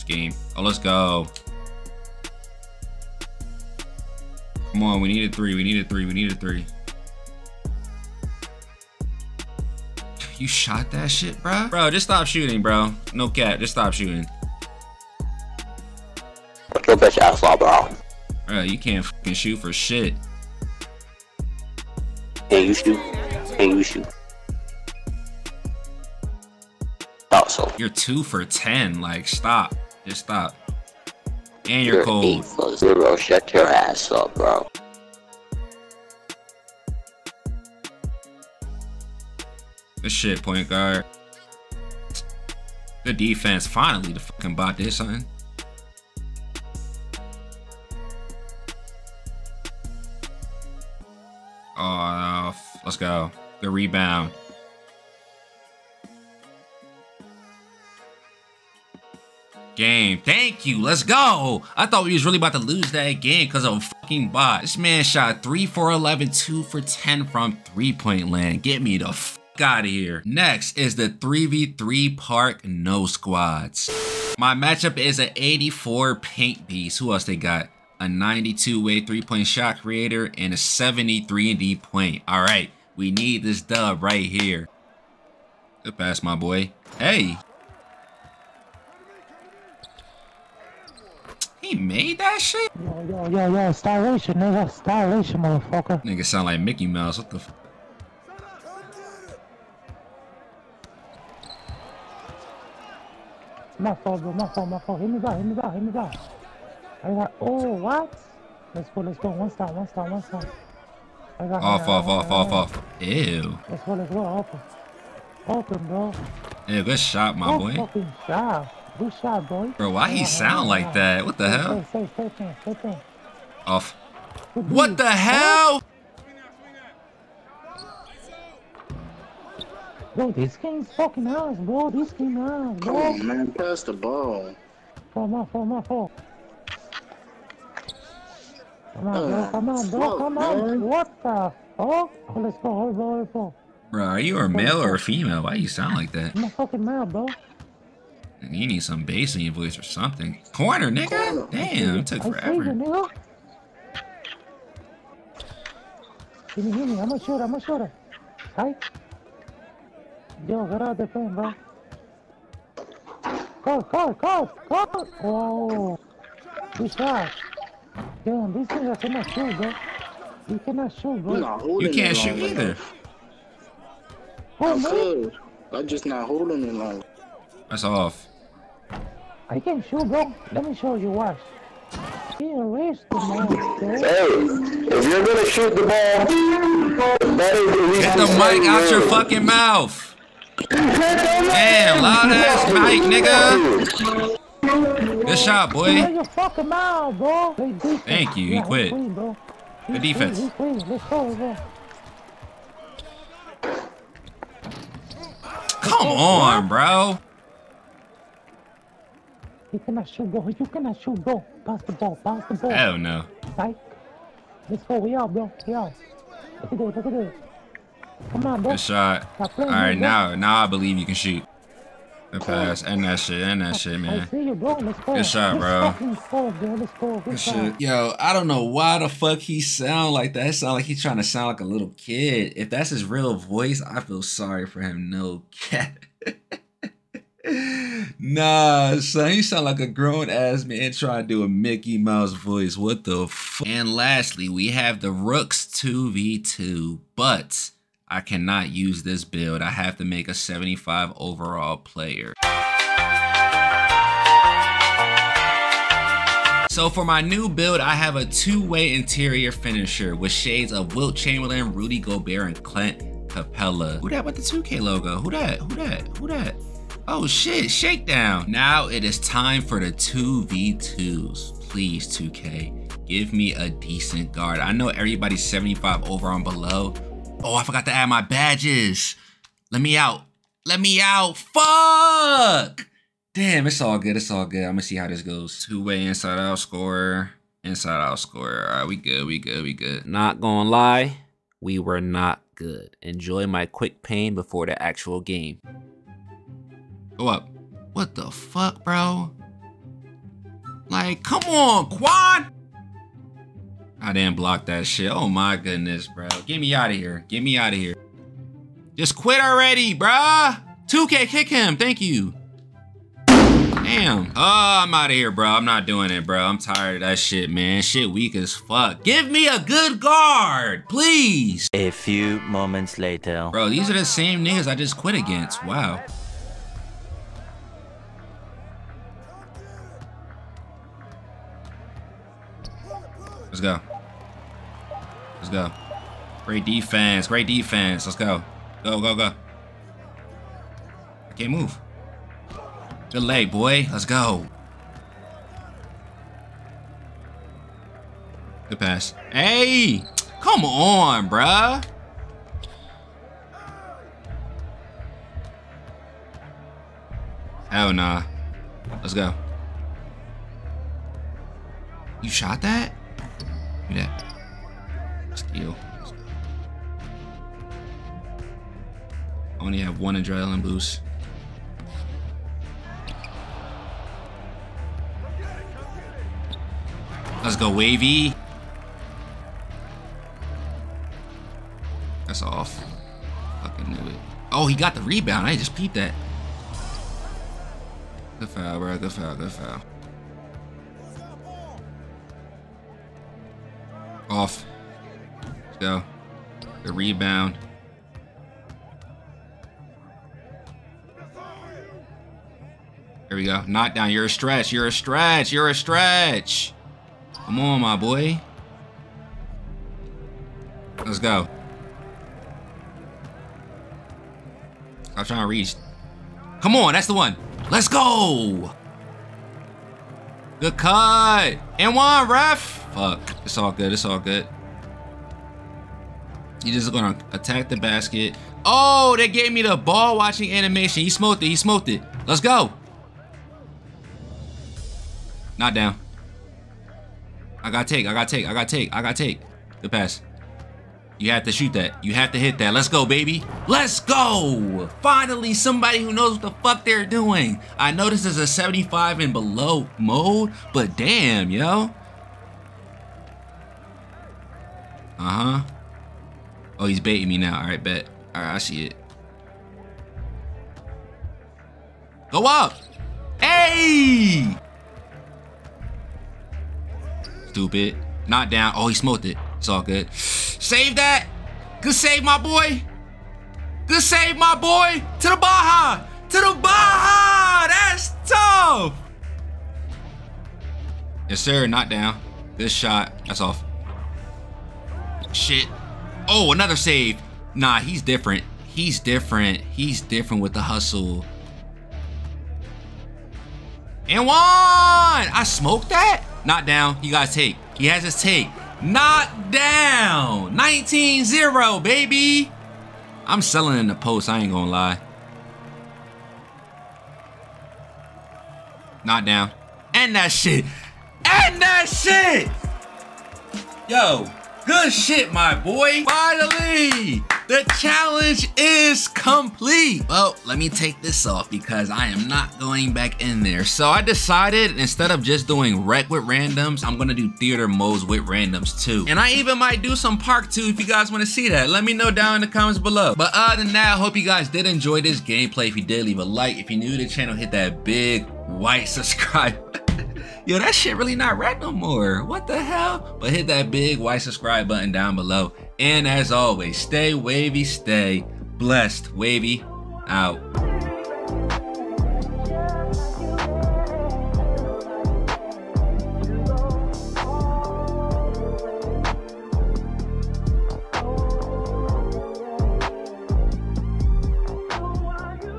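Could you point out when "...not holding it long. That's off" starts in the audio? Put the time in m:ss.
2:56.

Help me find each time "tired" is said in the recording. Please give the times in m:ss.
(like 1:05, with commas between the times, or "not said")
5:16.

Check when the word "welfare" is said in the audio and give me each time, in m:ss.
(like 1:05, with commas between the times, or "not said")
not said.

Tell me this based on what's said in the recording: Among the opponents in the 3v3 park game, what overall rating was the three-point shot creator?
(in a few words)
92.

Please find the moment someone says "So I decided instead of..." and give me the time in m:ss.
8:43.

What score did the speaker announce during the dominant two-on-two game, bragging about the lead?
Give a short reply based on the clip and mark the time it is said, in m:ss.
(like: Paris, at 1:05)
19-0, at 8:20.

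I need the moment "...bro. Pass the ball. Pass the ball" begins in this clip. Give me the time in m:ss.
3:31.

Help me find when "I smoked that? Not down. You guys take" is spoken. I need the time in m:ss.
8:14.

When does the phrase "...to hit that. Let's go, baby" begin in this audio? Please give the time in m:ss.
7:22.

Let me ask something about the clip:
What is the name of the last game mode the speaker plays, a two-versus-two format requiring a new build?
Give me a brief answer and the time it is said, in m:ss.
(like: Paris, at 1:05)
Rooks 2v2, at 4:05.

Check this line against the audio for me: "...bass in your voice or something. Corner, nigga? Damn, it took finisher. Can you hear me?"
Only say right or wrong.
wrong.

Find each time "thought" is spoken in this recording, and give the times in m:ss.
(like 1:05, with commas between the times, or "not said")
0:27, 1:01.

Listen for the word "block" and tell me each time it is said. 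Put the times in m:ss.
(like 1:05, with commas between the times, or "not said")
5:04.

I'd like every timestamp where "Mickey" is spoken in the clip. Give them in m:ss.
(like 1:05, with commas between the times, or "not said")
1:36, 4:01.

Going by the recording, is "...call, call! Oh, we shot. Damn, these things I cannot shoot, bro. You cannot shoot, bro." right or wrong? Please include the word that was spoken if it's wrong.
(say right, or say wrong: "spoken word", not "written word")
right.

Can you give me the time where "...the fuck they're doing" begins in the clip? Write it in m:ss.
7:26.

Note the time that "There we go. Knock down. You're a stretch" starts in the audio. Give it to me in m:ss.
6:43.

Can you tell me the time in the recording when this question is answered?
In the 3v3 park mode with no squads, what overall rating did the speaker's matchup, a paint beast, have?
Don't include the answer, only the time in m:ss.
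1:15.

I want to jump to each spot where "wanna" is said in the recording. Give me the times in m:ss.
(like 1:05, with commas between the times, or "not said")
8:51.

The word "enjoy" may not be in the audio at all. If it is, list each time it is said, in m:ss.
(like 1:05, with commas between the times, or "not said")
4:53, 8:54.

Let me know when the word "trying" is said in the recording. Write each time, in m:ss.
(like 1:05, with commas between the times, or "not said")
3:51, 4:00, 6:55.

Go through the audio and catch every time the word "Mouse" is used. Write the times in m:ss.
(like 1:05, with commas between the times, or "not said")
1:36, 4:01.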